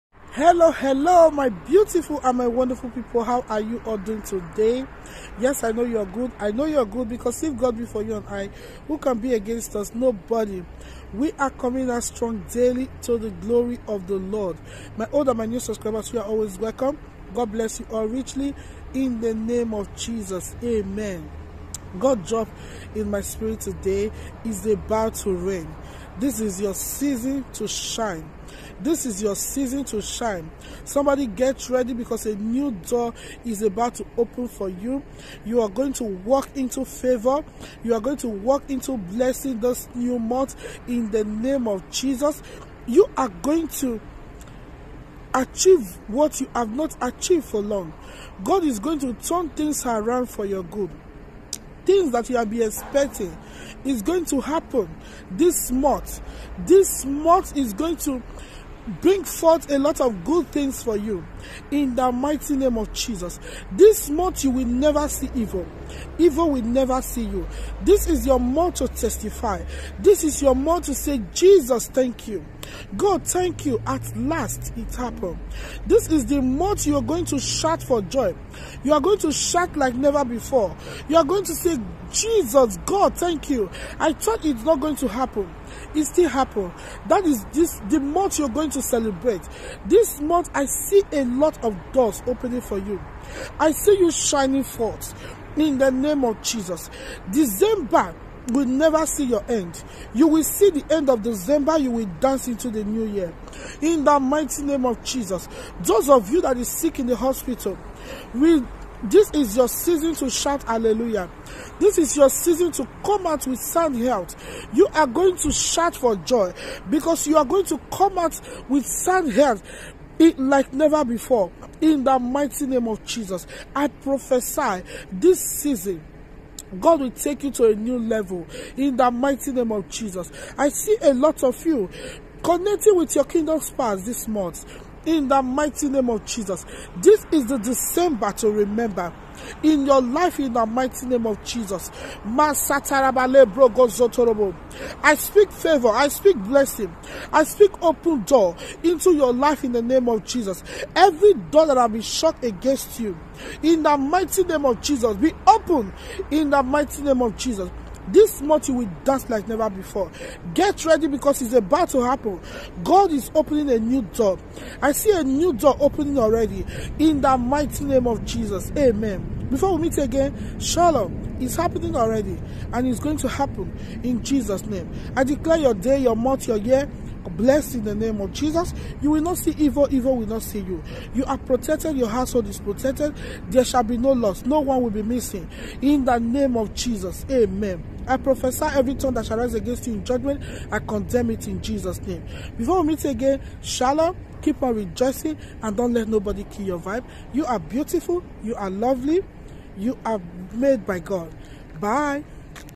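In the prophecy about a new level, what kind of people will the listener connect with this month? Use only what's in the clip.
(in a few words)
kingdom spans.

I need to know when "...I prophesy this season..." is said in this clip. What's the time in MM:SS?
02:03.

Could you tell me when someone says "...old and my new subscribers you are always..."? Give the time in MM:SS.
00:15.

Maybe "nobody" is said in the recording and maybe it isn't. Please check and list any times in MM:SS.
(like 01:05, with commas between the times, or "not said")
00:09, 03:16.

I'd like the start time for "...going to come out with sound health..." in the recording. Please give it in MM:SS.
01:57.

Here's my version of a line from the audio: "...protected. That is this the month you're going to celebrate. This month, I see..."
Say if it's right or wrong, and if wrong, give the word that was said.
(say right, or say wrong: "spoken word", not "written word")
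wrong: "happened", not "protected".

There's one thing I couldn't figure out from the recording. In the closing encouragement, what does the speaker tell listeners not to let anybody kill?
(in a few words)
your vibe.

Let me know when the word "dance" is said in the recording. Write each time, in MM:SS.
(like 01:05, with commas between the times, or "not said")
01:42, 02:39.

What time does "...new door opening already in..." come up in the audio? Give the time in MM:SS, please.
02:45.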